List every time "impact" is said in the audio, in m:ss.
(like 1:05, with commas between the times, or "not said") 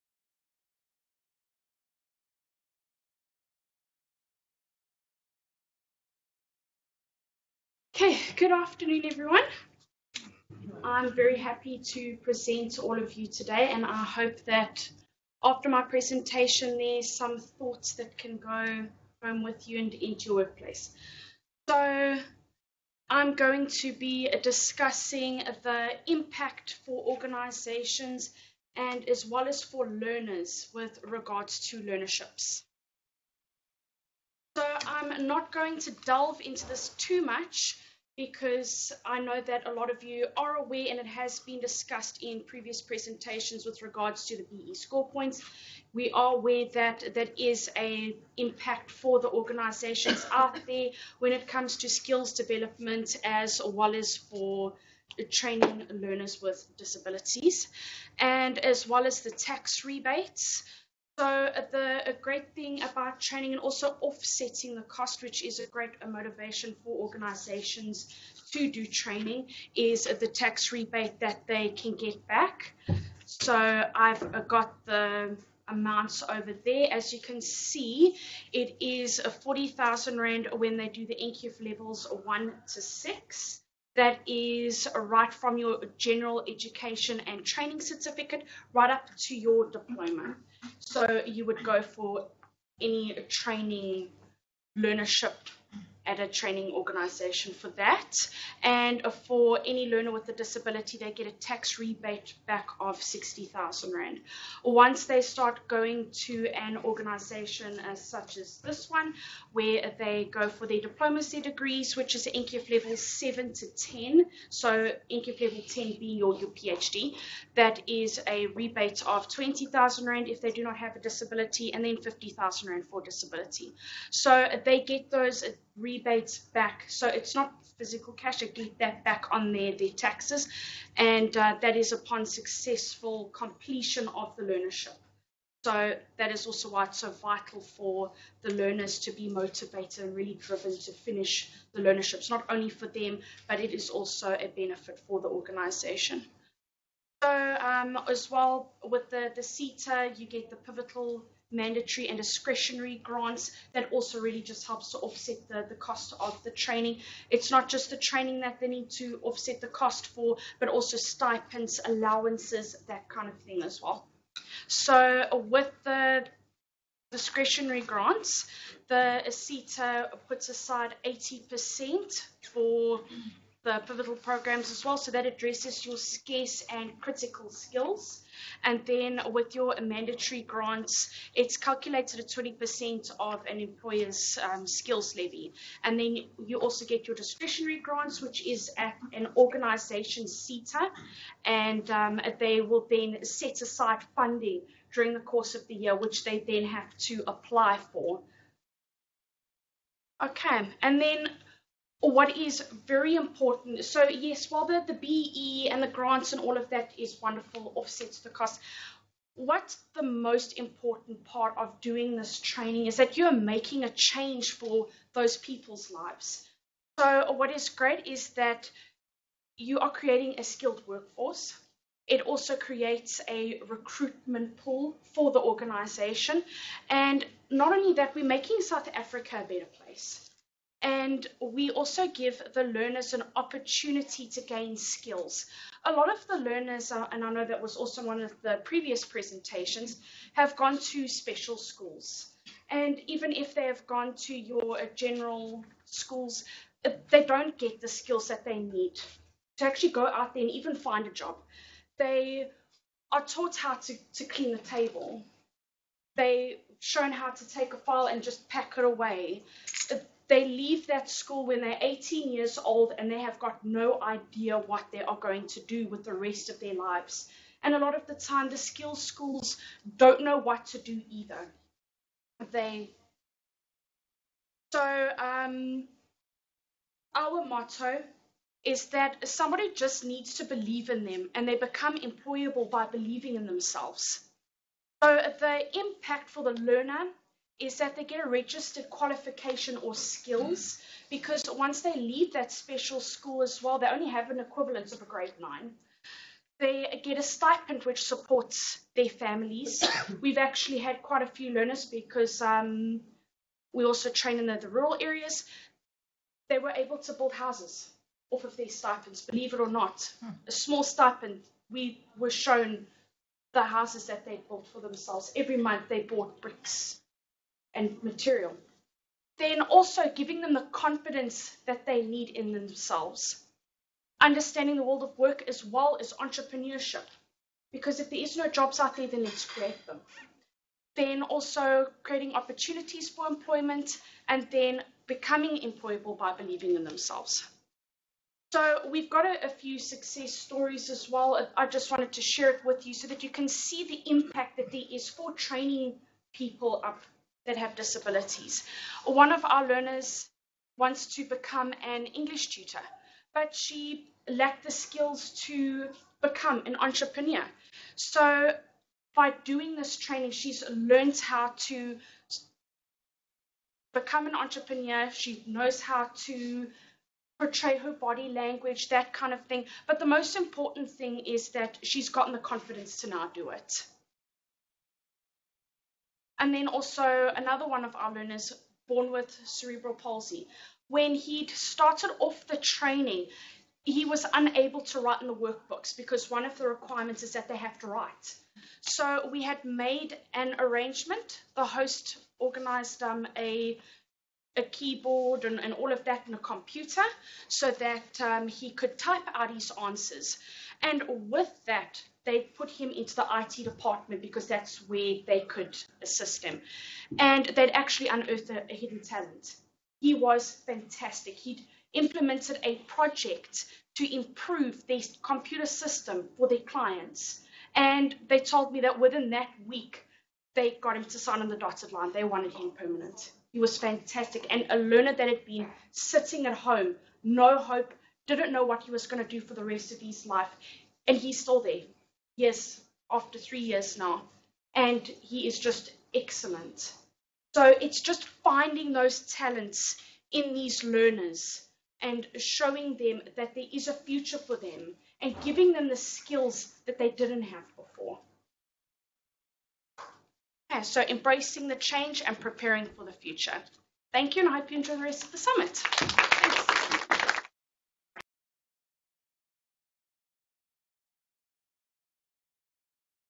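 0:26, 0:48, 4:45, 5:44.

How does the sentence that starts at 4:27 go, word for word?
And a lot of the time, the skills schools don't know what to do either.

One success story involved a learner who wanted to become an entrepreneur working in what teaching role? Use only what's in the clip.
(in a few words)
English tutor.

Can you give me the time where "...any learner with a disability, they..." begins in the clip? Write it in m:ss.
1:39.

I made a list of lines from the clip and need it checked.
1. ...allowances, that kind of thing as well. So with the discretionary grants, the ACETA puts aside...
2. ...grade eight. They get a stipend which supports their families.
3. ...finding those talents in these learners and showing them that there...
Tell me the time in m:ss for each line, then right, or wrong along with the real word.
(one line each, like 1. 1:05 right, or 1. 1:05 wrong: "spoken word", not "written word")
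1. 2:41 right
2. 4:55 wrong: "nine", not "eight"
3. 7:18 right.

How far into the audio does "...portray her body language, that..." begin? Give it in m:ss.
6:07.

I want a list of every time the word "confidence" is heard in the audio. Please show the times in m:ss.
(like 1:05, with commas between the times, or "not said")
5:20, 6:12.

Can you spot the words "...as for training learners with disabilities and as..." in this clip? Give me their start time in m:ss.
0:53.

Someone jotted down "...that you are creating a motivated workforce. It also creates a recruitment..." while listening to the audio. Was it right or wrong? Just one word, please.
wrong.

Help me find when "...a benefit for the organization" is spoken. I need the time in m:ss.
2:24.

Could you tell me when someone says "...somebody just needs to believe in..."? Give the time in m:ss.
4:39.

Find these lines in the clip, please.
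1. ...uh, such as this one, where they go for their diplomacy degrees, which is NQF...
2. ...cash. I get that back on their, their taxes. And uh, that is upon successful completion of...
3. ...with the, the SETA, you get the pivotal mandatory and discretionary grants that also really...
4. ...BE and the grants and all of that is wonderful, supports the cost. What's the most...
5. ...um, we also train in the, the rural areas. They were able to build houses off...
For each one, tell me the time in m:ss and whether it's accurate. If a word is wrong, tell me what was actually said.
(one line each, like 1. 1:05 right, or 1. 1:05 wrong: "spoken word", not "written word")
1. 1:47 right
2. 2:08 right
3. 2:28 right
4. 3:24 wrong: "offsets", not "supports"
5. 5:02 right.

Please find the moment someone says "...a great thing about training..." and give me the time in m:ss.
1:02.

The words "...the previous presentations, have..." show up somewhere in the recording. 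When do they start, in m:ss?
3:58.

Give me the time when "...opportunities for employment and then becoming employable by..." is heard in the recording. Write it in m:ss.
5:32.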